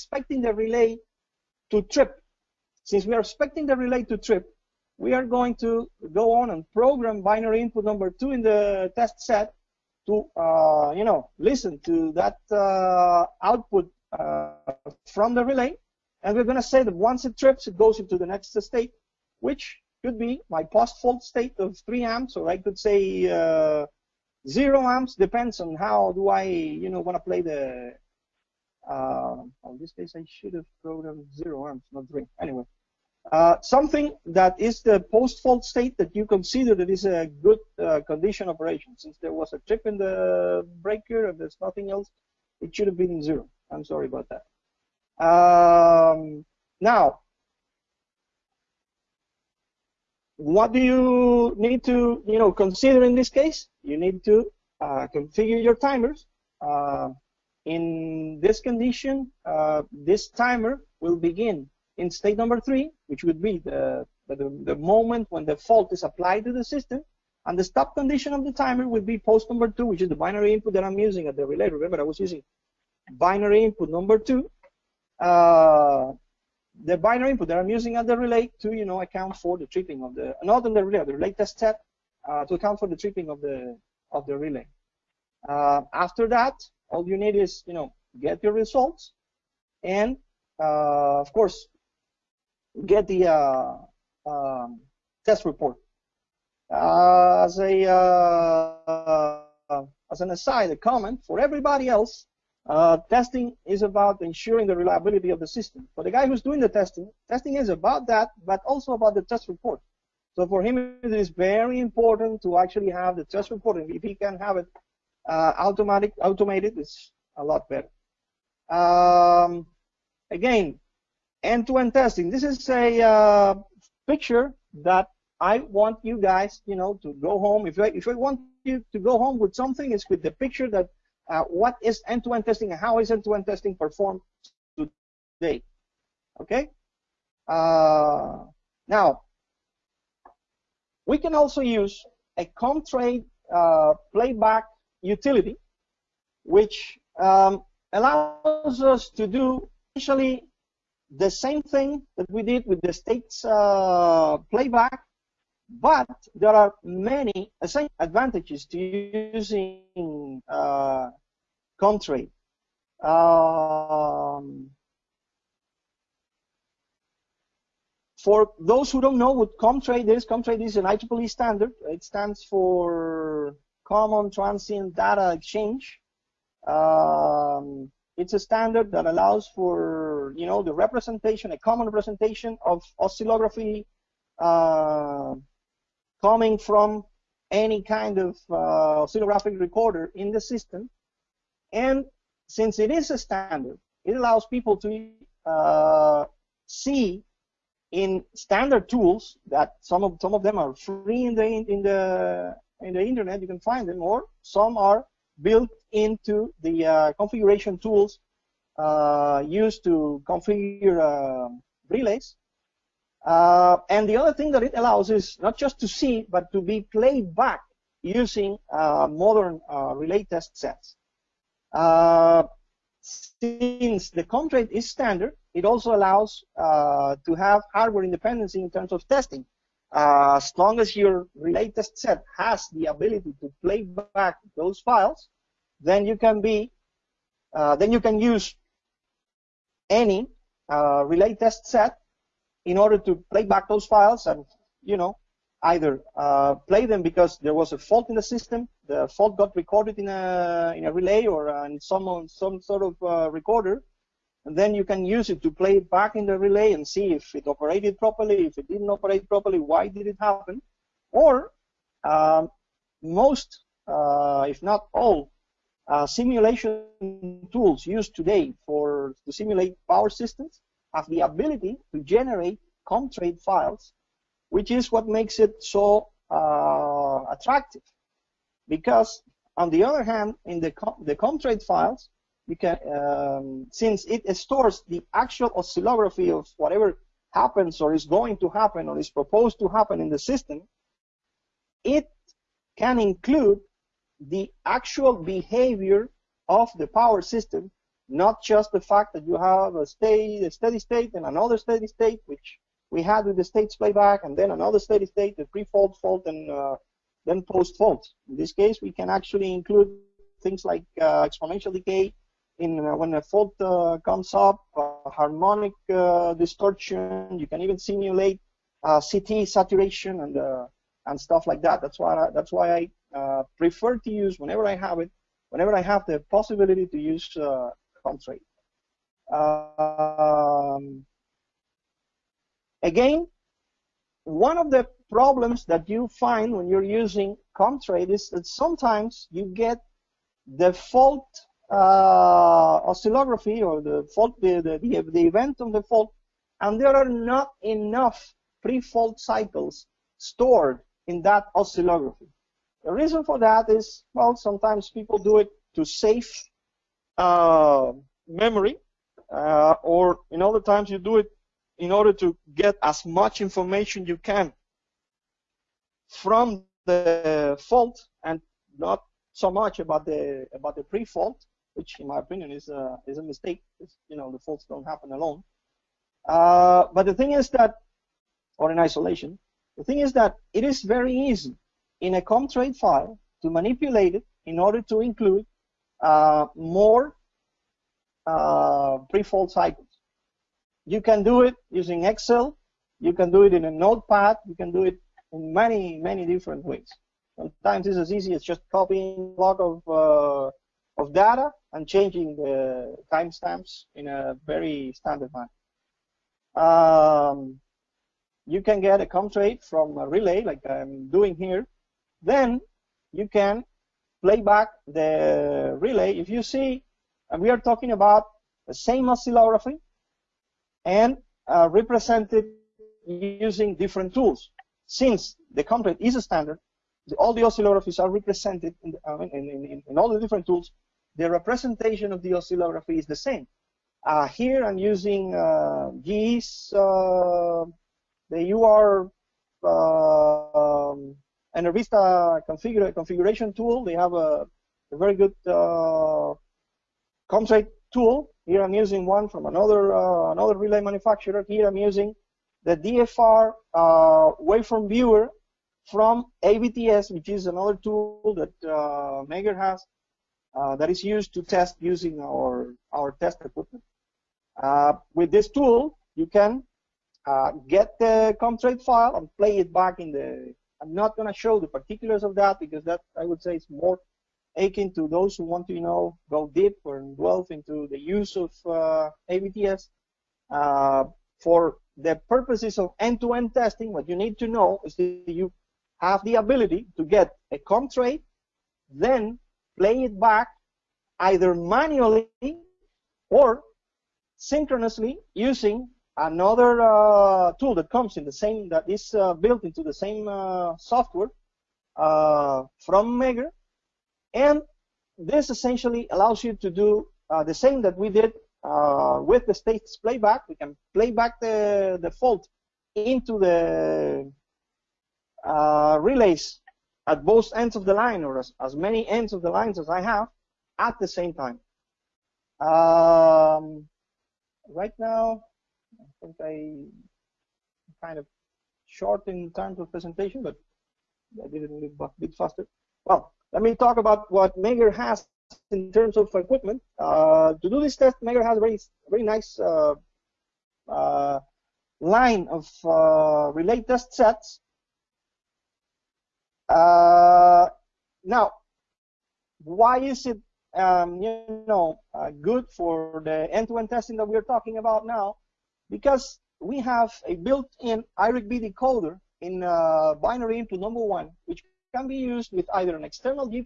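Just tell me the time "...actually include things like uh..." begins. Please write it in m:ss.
5:09.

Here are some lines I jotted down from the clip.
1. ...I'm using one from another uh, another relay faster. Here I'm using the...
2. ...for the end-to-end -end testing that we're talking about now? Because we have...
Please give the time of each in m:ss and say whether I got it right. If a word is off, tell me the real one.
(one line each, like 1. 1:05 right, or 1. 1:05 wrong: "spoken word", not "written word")
1. 7:28 wrong: "manufacturer", not "faster"
2. 9:12 right.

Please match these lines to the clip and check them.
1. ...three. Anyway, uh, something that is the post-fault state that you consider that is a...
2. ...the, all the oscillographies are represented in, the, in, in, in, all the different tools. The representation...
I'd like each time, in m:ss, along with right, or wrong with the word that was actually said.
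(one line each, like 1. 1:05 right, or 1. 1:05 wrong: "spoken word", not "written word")
1. 0:32 right
2. 7:07 right.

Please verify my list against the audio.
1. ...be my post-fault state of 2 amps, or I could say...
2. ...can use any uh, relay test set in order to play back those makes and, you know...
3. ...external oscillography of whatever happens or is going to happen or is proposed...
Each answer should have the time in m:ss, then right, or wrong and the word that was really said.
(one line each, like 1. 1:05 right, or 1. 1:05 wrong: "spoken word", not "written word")
1. 0:20 wrong: "3", not "2"
2. 3:58 wrong: "files", not "makes"
3. 4:45 wrong: "actual", not "external".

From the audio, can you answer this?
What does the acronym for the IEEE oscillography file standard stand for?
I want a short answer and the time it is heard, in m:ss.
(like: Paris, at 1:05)
Common Transient Data Exchange, at 2:53.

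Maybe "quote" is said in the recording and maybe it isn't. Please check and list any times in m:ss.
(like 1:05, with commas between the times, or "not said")
not said.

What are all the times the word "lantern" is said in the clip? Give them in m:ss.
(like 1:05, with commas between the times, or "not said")
not said.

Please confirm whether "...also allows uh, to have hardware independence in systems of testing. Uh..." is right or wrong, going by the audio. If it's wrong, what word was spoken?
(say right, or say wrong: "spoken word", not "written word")
wrong: "terms", not "systems".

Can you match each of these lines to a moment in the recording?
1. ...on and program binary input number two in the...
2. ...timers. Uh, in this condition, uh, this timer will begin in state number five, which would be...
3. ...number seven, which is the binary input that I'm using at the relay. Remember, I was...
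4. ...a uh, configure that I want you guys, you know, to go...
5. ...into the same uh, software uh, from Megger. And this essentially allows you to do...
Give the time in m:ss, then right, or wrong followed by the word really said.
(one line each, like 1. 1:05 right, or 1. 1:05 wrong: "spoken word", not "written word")
1. 0:06 right
2. 0:55 wrong: "three", not "five"
3. 1:09 wrong: "two", not "seven"
4. 2:02 wrong: "picture", not "configure"
5. 8:19 right.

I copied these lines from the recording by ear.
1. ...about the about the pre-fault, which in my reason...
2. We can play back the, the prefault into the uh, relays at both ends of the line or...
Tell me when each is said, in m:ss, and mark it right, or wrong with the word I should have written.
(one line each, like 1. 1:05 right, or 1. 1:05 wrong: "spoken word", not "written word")
1. 6:09 wrong: "opinion", not "reason"
2. 8:30 wrong: "fault", not "prefault".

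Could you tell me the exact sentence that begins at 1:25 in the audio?
Uh, after that, all you need is you know get your results, and uh, of course get the um, test report.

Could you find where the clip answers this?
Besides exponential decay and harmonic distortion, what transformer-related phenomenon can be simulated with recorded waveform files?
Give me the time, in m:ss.
5:18.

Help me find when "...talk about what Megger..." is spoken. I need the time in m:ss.
8:53.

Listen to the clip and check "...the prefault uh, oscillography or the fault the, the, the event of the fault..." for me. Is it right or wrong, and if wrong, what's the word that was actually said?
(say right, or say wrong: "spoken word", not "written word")
wrong: "fault", not "prefault".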